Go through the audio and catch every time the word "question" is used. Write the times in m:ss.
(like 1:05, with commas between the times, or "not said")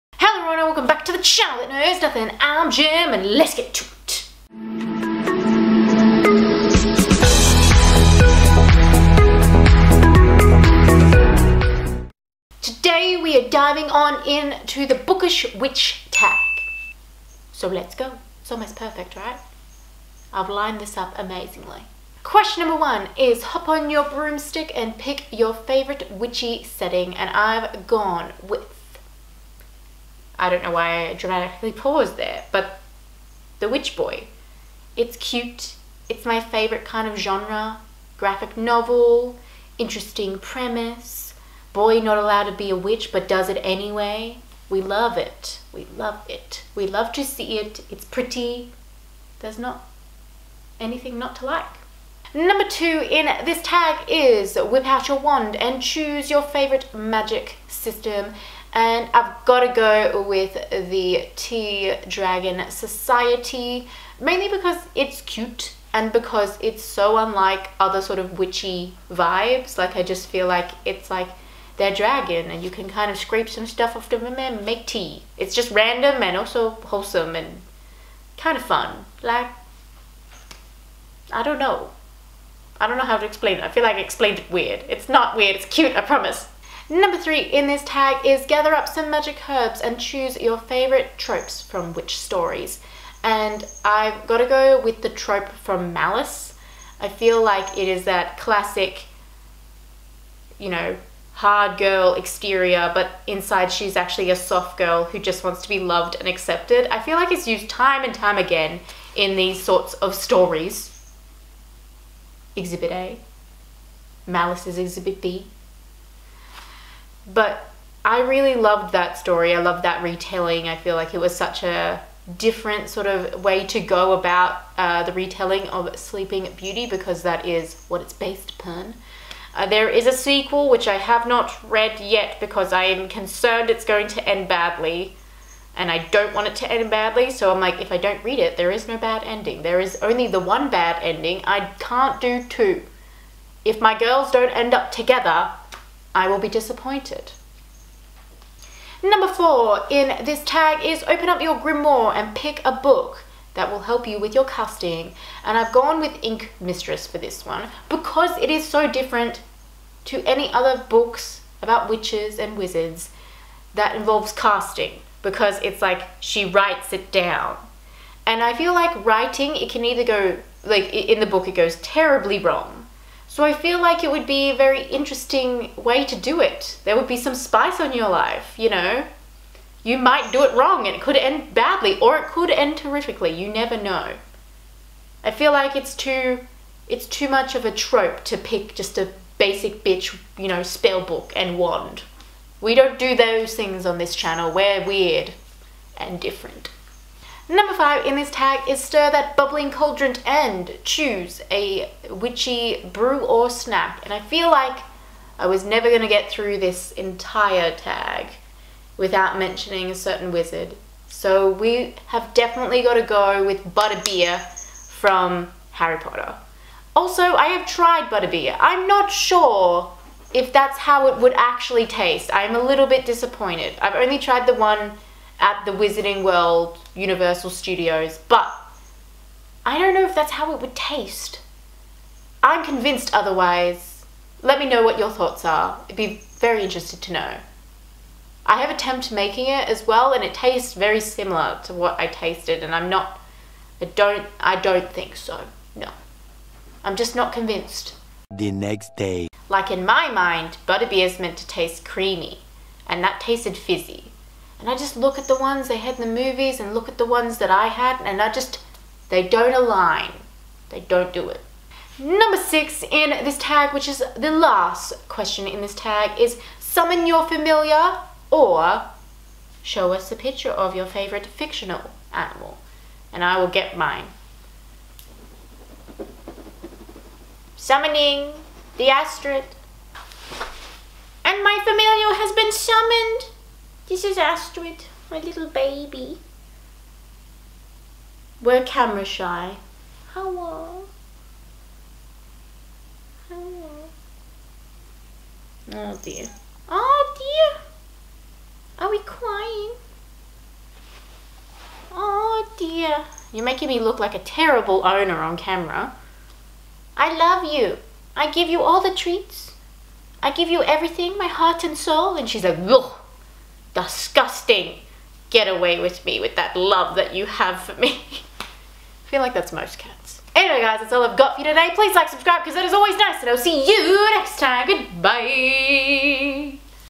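0:22, 4:25.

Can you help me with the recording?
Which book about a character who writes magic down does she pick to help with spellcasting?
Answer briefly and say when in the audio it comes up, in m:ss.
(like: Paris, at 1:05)
Ink Mistress, at 2:36.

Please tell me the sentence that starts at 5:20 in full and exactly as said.
Anyway guys, that's all I've got for you today.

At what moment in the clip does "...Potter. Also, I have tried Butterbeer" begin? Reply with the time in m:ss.
3:35.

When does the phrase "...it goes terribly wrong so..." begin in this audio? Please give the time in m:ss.
2:51.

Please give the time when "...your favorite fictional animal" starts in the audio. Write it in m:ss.
4:30.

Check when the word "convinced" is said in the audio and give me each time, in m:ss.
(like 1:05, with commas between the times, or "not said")
3:52, 4:07.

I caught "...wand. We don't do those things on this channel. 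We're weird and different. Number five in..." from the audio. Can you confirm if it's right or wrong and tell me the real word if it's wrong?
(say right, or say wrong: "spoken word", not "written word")
right.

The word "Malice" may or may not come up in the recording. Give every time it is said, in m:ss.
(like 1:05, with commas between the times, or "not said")
1:35, 1:54.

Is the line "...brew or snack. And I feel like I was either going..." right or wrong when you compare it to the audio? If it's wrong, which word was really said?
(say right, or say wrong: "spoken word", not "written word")
wrong: "never", not "either".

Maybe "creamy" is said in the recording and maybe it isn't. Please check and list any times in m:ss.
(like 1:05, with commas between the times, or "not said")
4:11.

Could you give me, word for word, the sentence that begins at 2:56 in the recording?
There would be some spice on your life, you know?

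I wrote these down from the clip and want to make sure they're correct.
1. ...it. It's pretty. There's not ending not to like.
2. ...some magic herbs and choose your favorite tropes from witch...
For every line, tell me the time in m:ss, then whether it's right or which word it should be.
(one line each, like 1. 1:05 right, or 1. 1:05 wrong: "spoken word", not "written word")
1. 0:47 wrong: "anything", not "ending"
2. 1:28 right.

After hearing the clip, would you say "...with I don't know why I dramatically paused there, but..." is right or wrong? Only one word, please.
right.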